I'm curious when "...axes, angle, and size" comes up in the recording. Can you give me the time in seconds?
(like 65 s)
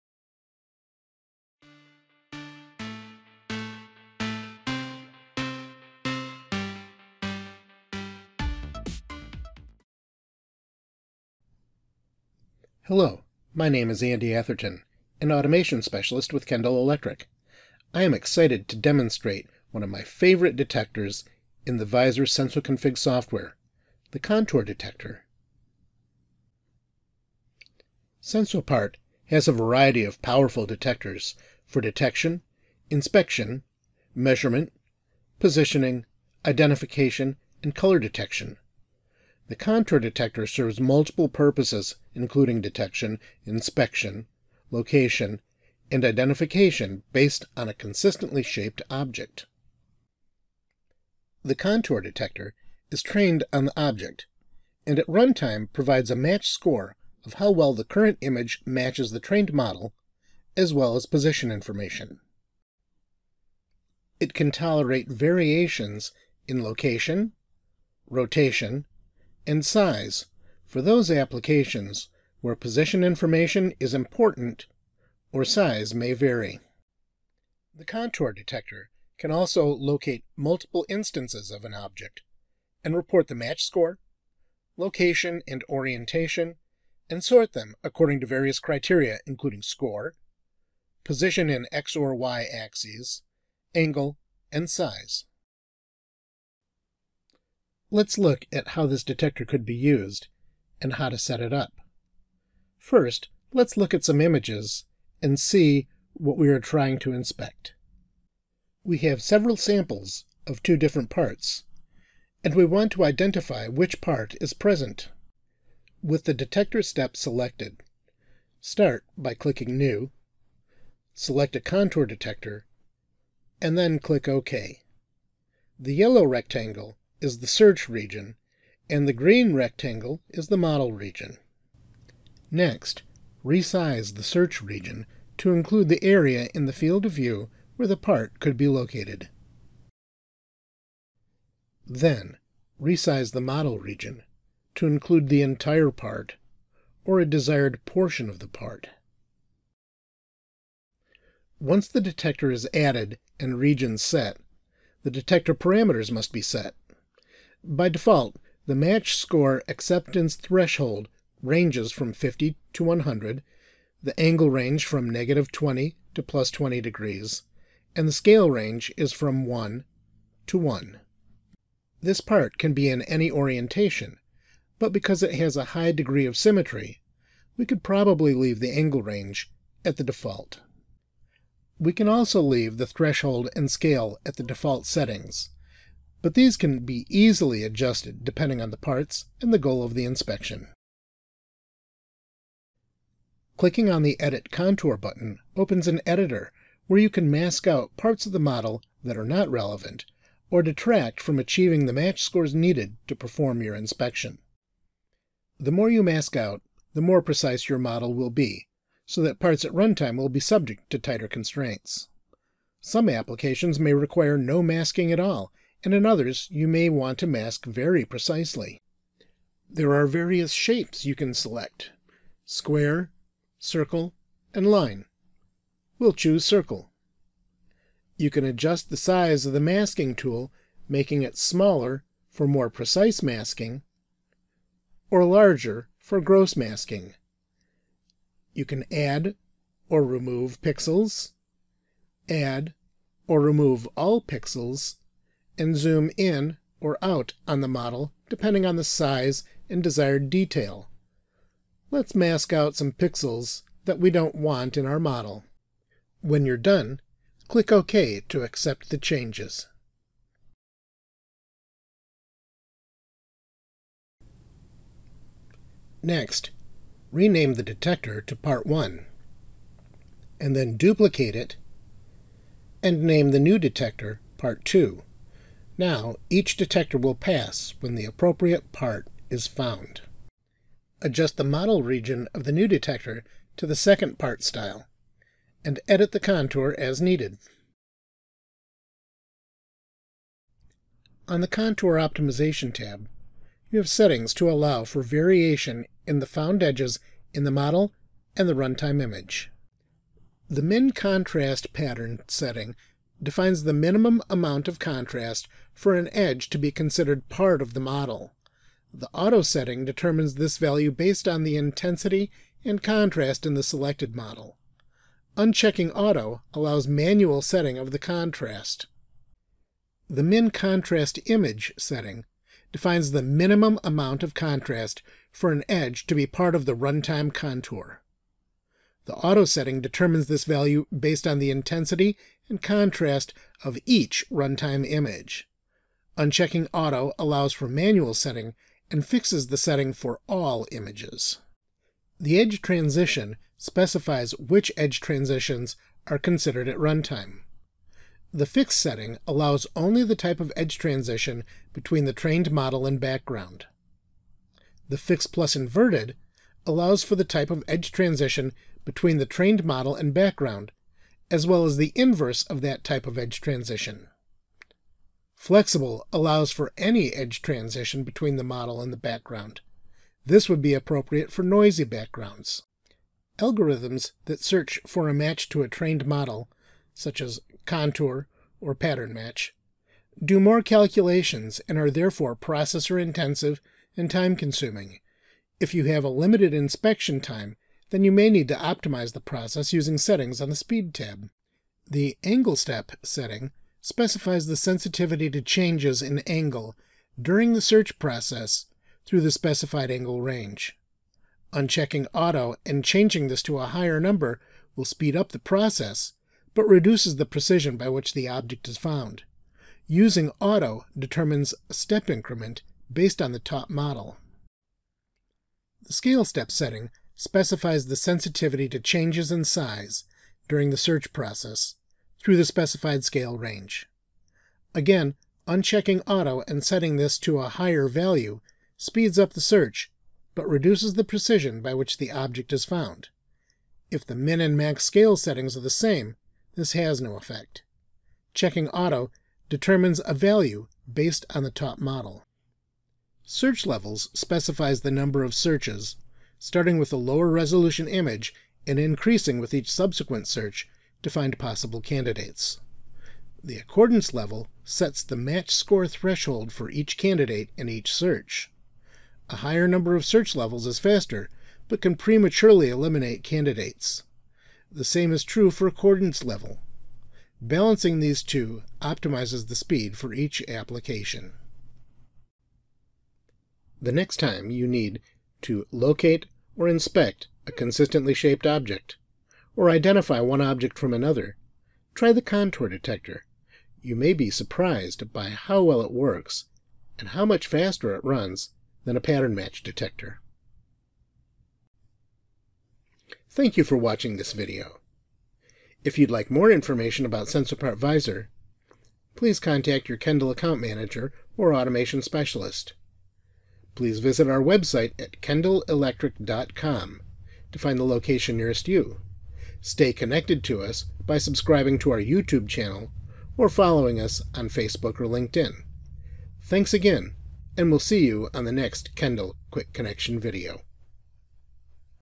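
92 s.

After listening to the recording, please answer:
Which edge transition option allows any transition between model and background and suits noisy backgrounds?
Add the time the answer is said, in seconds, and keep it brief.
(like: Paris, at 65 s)
Flexible, at 365 s.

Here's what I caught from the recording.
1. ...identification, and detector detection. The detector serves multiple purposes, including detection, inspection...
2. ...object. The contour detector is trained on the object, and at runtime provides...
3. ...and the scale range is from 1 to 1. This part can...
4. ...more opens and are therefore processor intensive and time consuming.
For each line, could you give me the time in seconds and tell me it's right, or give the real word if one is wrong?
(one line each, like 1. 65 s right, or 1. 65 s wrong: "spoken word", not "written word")
1. 36 s wrong: "color", not "detector"
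2. 48 s right
3. 167 s right
4. 380 s wrong: "calculations", not "opens".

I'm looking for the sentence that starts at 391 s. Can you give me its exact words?
The Angle Step setting specifies the sensitivity to changes in angle during the search process through the specified angle range.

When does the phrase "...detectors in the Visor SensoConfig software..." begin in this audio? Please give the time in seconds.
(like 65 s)
20 s.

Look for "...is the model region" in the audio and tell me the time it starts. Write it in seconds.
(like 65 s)
130 s.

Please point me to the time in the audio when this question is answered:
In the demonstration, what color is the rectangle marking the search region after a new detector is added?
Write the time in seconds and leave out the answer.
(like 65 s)
125 s.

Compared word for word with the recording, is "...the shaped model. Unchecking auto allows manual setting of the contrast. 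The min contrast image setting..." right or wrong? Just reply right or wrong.
wrong.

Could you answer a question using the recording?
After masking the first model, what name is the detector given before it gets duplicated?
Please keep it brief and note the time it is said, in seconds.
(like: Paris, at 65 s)
Part 1, at 268 s.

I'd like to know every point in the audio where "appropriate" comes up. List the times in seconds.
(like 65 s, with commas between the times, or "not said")
278 s, 370 s.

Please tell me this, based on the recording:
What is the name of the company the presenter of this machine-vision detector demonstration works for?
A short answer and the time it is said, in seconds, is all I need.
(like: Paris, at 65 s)
Kendall Electric, at 16 s.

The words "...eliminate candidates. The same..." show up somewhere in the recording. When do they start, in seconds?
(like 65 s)
462 s.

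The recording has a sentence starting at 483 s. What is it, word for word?
You may be surprised by how well it works and how much faster it runs than a pattern match detector.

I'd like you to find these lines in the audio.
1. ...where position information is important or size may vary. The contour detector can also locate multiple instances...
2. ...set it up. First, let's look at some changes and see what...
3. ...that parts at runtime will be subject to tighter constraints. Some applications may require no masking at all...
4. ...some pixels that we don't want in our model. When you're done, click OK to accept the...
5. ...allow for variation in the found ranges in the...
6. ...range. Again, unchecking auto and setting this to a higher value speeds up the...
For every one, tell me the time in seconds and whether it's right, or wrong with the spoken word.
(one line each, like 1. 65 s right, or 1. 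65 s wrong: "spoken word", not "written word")
1. 72 s right
2. 101 s wrong: "images", not "changes"
3. 209 s right
4. 252 s right
5. 294 s wrong: "edges", not "ranges"
6. 423 s right.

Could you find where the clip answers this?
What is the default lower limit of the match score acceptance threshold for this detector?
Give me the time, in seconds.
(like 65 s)
162 s.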